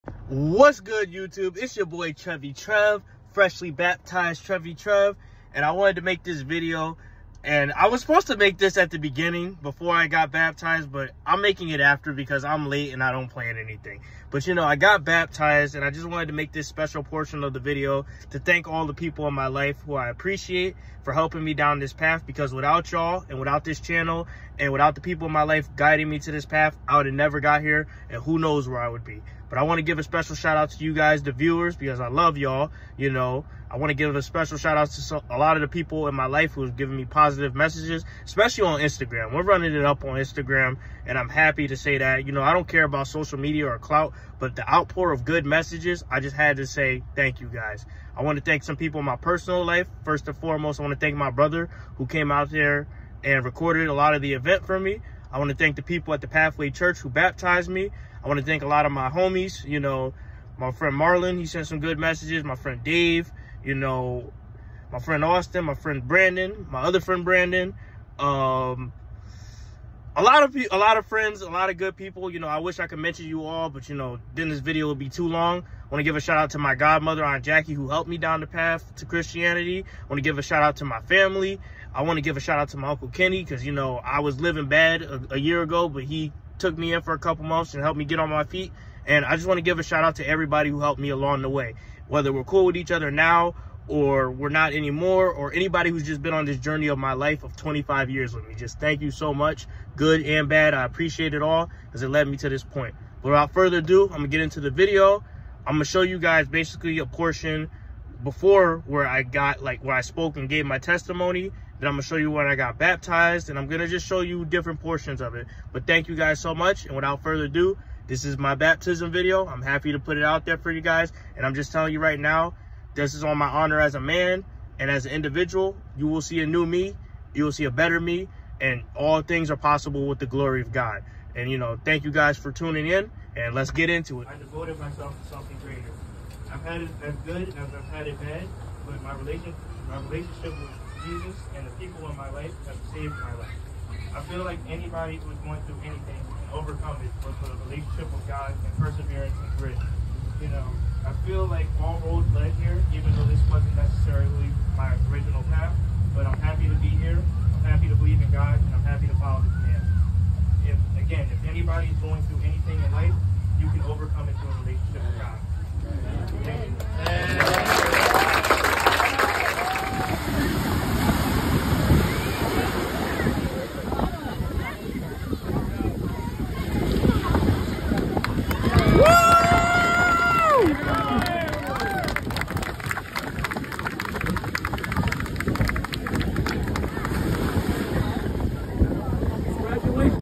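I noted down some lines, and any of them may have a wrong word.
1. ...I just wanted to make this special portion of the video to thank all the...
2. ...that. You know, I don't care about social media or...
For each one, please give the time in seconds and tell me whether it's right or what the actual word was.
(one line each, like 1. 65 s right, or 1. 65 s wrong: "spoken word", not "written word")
1. 15 s right
2. 41 s right.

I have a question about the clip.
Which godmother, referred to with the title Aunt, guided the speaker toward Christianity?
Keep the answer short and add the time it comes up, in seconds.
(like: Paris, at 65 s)
Aunt Jackie, at 77 s.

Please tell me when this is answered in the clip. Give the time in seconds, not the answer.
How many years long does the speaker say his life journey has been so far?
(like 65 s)
97 s.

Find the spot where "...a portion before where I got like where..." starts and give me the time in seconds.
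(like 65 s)
106 s.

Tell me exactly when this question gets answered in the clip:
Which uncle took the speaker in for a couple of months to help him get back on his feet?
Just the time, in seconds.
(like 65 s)
82 s.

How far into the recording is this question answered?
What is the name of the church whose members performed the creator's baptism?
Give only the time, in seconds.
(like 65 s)
56 s.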